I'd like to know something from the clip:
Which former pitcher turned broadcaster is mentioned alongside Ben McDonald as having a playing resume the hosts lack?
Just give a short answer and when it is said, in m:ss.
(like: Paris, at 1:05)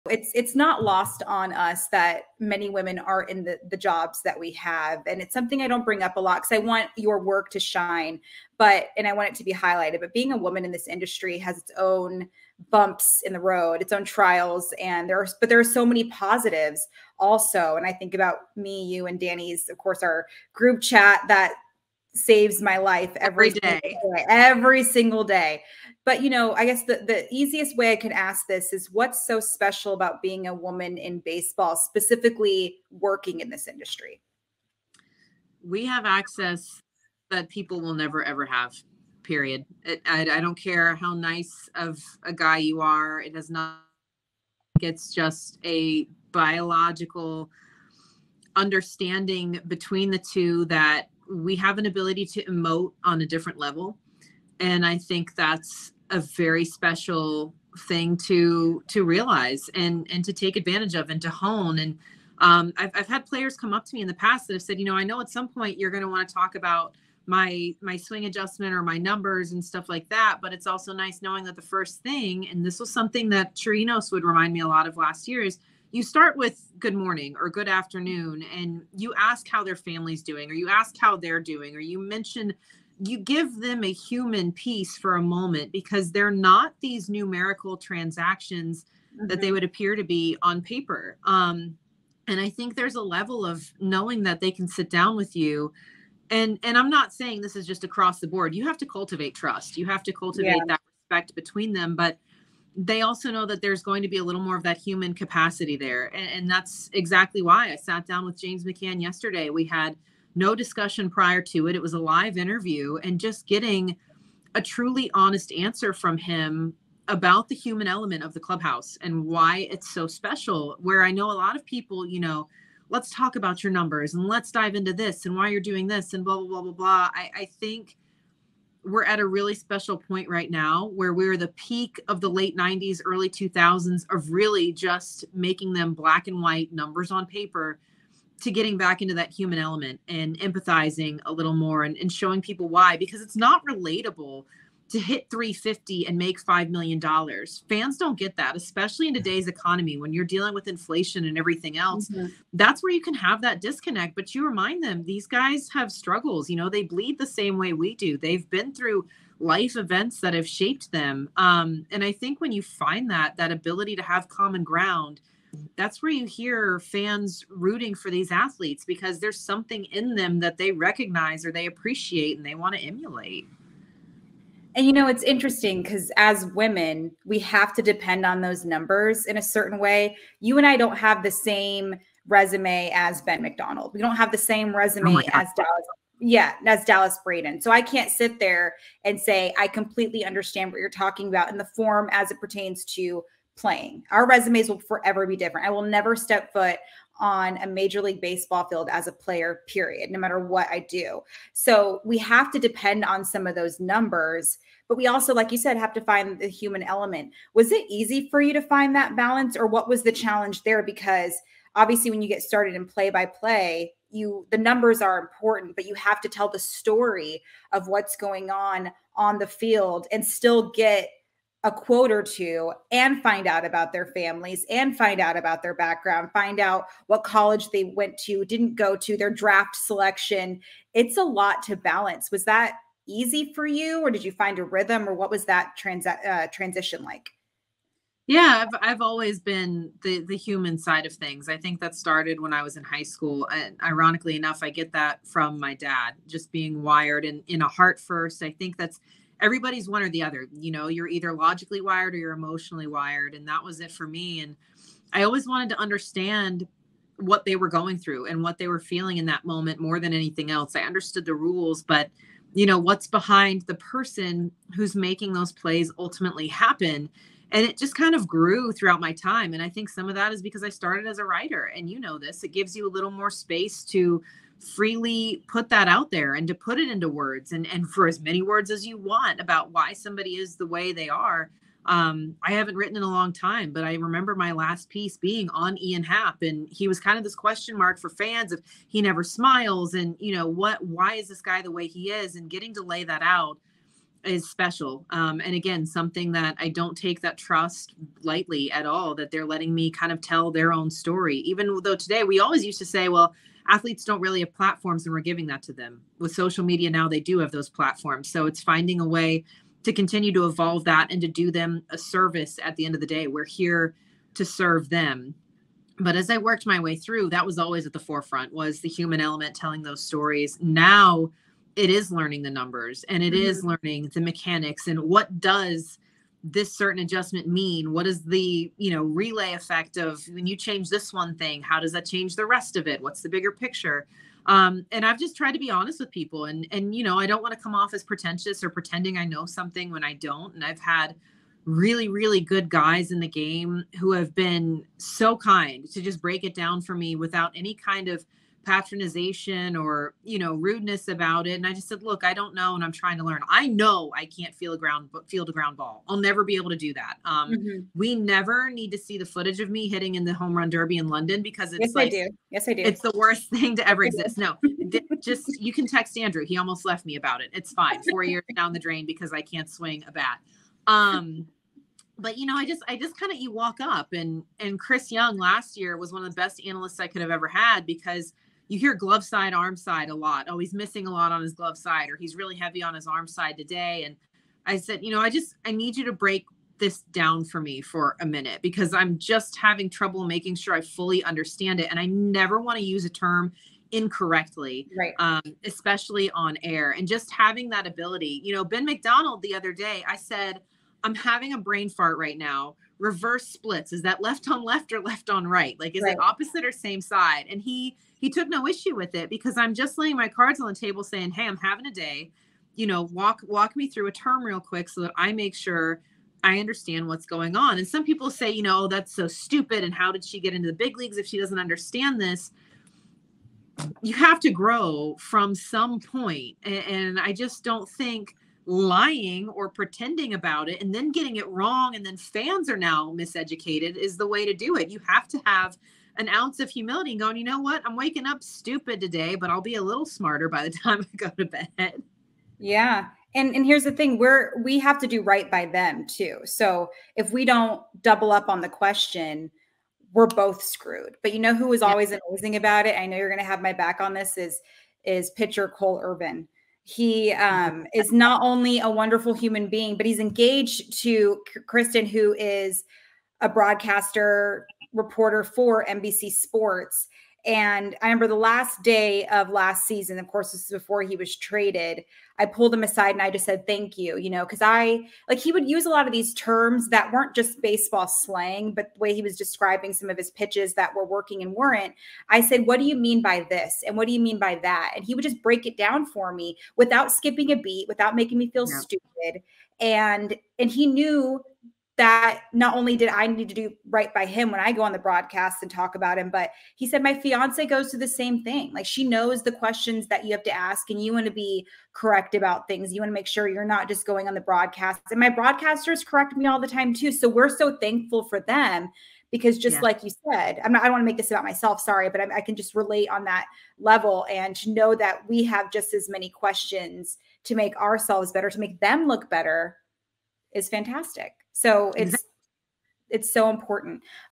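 Dallas Braden, at 3:06.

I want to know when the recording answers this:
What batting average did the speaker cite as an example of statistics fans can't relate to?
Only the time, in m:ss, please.
2:25.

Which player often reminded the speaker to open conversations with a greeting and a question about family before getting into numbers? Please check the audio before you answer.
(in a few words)
Chirinos.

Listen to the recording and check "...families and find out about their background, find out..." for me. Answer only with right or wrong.
right.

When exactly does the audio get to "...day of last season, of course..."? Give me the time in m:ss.
7:48.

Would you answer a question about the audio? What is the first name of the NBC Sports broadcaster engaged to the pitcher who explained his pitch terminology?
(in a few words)
Kristen.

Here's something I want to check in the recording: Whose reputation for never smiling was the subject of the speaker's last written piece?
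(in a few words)
Ian Happ.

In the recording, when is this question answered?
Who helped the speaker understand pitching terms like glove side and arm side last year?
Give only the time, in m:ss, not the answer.
6:14.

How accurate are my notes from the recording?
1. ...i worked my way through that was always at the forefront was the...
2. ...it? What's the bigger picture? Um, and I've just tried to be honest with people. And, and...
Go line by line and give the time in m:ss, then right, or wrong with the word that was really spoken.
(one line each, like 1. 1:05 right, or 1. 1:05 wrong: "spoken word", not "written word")
1. 5:16 right
2. 5:32 right.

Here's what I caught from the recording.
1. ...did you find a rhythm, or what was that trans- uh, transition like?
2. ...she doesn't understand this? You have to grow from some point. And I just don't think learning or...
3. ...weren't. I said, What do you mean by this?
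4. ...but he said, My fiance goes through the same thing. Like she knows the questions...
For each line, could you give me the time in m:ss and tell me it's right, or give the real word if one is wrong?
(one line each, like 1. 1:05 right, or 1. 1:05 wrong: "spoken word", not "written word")
1. 3:54 right
2. 7:01 wrong: "lying", not "learning"
3. 8:01 right
4. 8:16 right.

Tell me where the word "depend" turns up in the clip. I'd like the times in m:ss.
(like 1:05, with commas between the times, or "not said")
2:57, 3:22.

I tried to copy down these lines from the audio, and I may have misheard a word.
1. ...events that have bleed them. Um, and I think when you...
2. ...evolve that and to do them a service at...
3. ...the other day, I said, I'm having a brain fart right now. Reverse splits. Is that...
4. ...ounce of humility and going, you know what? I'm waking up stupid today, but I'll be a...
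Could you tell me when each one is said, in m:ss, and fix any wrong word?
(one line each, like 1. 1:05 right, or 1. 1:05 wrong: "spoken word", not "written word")
1. 2:39 wrong: "shaped", not "bleed"
2. 5:10 right
3. 6:39 right
4. 7:16 right.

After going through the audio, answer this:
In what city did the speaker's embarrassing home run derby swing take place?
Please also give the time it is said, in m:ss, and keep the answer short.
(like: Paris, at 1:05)
London, at 6:01.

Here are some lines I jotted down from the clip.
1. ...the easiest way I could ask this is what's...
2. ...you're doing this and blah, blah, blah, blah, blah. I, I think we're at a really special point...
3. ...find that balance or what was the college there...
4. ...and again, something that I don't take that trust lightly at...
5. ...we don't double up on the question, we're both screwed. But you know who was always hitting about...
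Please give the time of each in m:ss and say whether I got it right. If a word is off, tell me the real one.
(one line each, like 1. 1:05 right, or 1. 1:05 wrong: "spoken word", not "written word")
1. 0:27 right
2. 2:05 right
3. 3:28 wrong: "challenge", not "college"
4. 4:55 right
5. 7:27 wrong: "amazing", not "hitting".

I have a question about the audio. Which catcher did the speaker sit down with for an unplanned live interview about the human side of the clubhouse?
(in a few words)
James McCann.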